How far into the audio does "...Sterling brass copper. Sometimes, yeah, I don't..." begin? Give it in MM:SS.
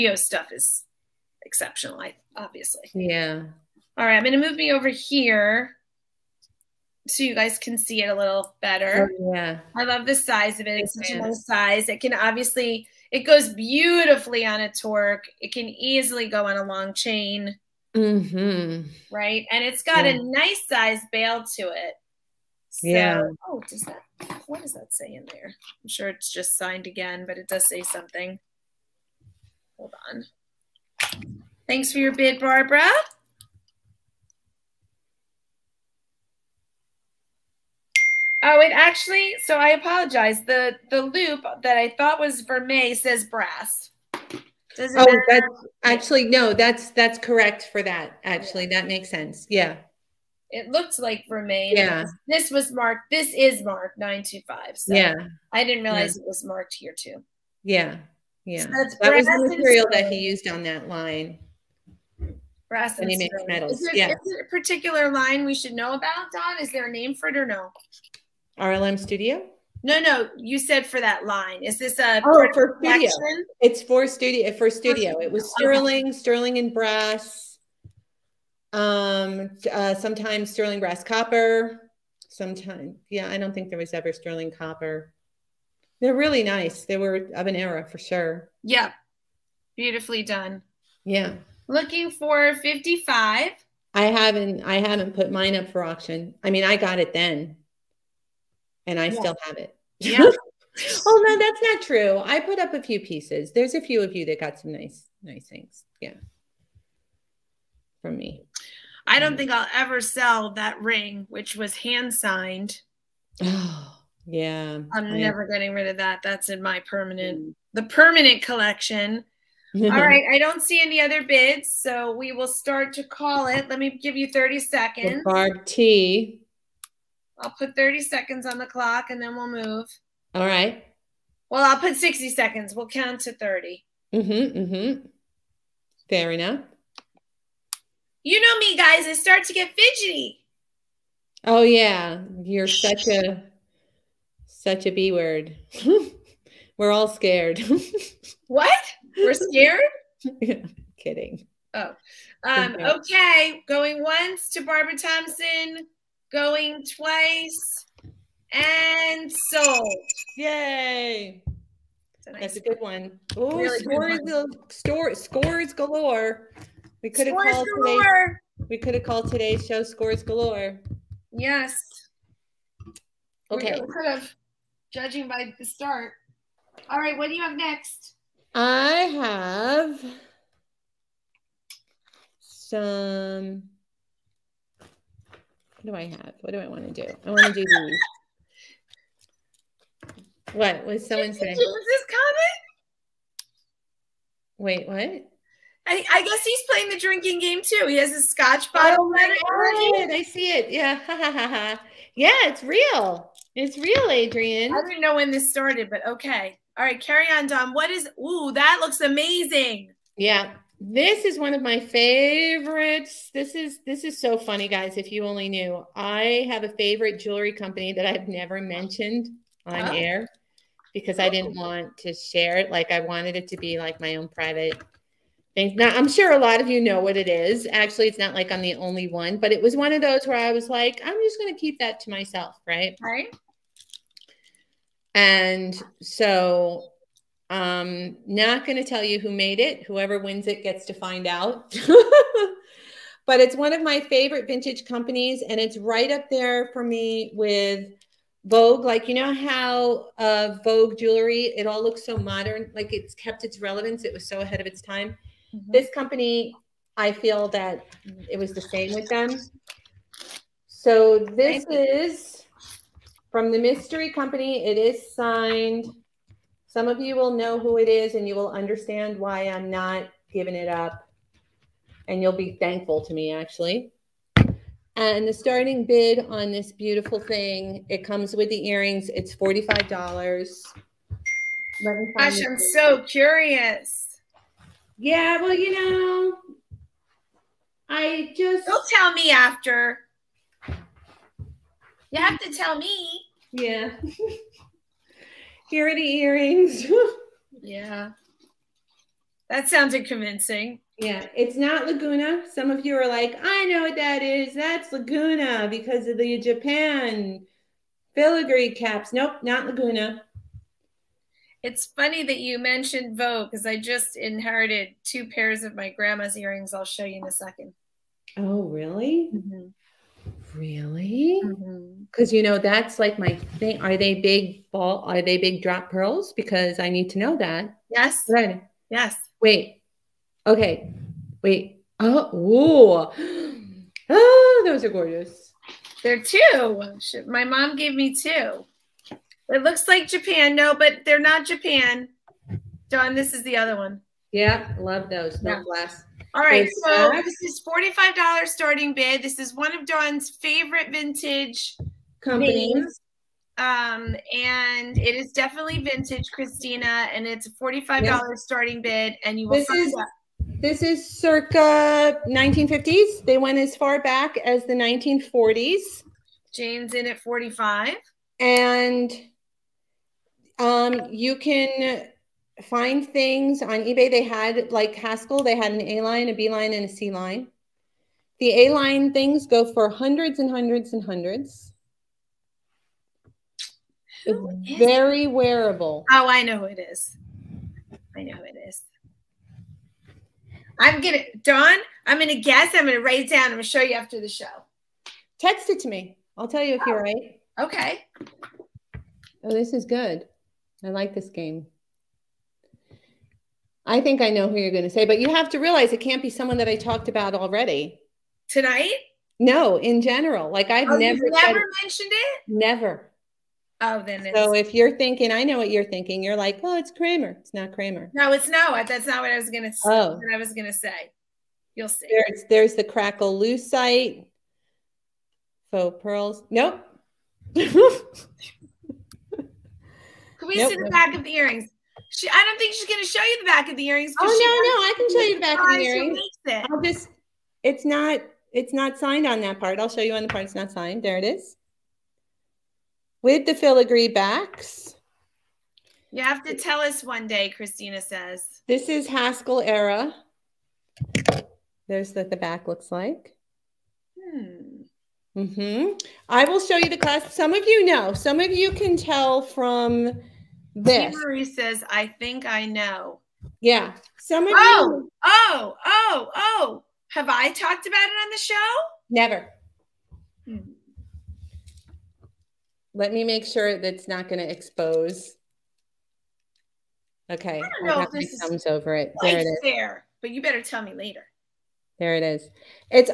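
01:20.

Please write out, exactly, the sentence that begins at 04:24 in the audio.
It is signed some of you will know who it is and you will understand why I'm not giving it up.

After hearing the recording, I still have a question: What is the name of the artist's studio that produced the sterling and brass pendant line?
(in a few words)
RLM Studio.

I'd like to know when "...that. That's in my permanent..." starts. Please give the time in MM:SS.
01:55.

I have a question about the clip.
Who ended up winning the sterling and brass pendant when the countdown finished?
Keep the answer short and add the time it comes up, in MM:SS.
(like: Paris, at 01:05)
Barbara Thompson, at 02:34.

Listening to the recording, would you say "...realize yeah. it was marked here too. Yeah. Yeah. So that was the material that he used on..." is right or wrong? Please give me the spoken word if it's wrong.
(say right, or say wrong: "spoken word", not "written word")
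right.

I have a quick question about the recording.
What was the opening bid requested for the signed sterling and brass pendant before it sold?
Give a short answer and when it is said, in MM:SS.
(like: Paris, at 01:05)
$55, at 01:32.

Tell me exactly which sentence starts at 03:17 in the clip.
He has a scotch oh bottle.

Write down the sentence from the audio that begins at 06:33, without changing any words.
I'm gonna show you after the show.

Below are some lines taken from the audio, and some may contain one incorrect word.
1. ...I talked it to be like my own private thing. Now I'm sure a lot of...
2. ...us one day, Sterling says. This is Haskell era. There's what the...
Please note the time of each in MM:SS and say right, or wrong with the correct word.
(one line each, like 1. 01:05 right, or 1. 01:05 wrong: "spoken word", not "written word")
1. 03:42 wrong: "wanted", not "talked"
2. 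07:26 wrong: "Christina", not "Sterling".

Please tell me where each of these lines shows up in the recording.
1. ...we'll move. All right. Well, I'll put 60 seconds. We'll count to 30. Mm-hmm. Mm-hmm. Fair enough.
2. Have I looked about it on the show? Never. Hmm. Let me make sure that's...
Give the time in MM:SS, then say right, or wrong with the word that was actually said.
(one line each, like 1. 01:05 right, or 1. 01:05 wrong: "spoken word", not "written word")
1. 02:09 right
2. 07:47 wrong: "talked", not "looked".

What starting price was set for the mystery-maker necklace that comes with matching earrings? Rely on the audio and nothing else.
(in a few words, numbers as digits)
$45.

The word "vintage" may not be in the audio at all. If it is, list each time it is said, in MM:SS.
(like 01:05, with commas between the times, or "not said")
04:04, 05:50, 05:55.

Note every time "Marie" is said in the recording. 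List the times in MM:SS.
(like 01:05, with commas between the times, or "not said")
07:41.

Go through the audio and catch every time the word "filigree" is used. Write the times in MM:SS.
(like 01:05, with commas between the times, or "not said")
05:08, 07:23.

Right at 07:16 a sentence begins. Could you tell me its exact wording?
I'll just, it's not, it's not signed on that part.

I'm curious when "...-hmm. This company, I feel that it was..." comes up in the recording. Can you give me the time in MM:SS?
04:15.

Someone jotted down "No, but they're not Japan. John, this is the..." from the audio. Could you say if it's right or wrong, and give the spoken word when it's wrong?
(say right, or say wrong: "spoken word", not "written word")
right.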